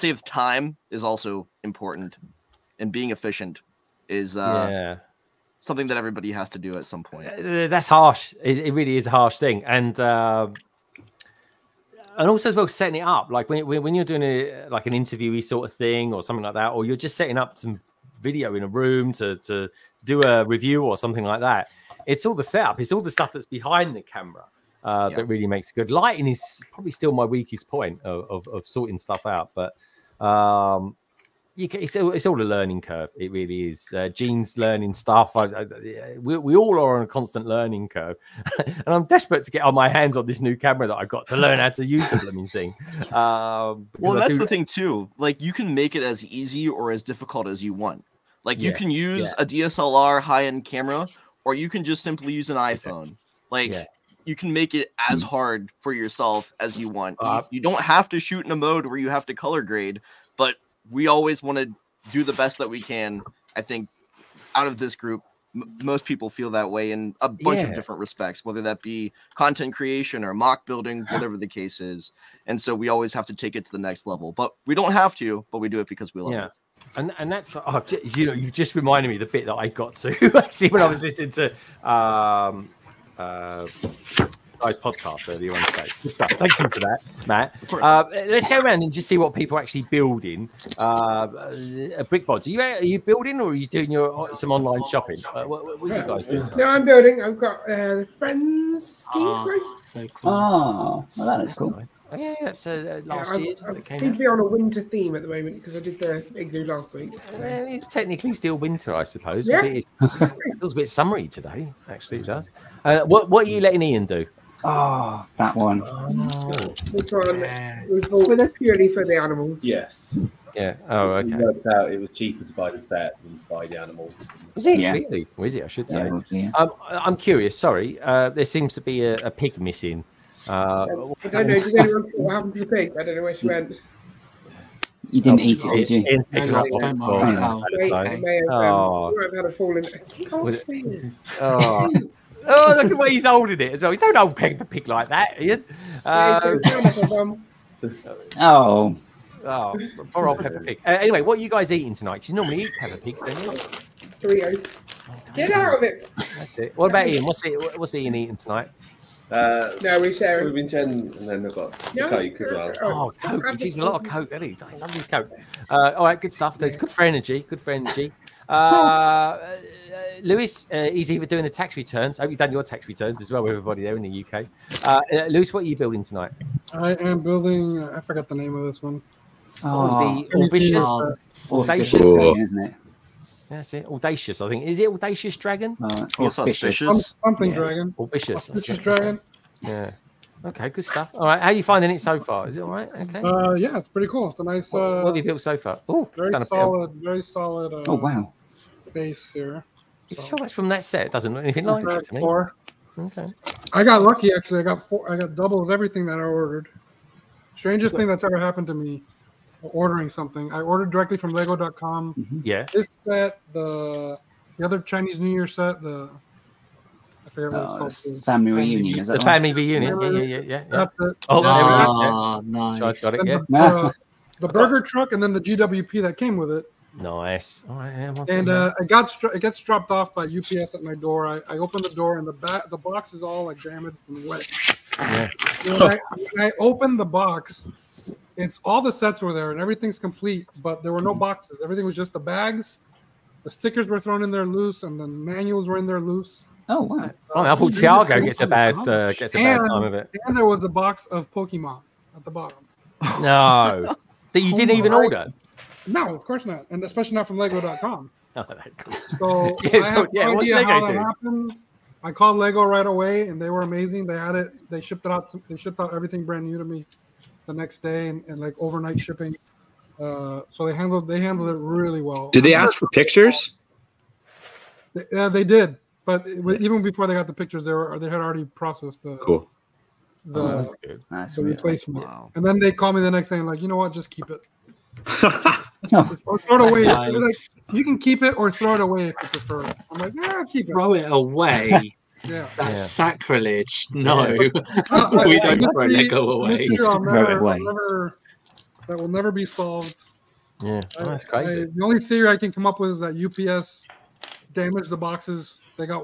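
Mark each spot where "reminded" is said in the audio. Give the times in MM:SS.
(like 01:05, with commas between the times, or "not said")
01:18.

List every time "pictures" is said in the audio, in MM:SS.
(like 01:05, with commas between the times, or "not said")
04:32, 04:37.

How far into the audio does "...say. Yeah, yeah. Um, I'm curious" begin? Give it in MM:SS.
02:05.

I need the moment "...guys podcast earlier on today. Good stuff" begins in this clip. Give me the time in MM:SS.
01:24.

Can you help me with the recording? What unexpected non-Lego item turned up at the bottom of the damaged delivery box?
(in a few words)
Pokemon.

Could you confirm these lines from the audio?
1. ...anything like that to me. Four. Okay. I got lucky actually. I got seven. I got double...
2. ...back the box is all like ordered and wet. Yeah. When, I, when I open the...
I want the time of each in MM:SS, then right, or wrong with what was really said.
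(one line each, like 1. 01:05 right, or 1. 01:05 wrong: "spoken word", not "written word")
1. 03:21 wrong: "four", not "seven"
2. 03:52 wrong: "damaged", not "ordered".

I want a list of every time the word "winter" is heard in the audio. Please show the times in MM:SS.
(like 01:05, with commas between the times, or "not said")
01:44, 01:48.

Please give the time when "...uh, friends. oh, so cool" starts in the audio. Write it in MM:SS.
01:37.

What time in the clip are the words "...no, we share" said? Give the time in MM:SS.
02:39.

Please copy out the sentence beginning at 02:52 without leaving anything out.
I hope you've done your tax returns as well, everybody there in the UK.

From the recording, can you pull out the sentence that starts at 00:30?
Um, you can, it's, it's all a learning curve.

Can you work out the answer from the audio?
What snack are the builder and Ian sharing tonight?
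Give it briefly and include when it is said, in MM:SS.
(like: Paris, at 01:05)
Doritos, at 02:34.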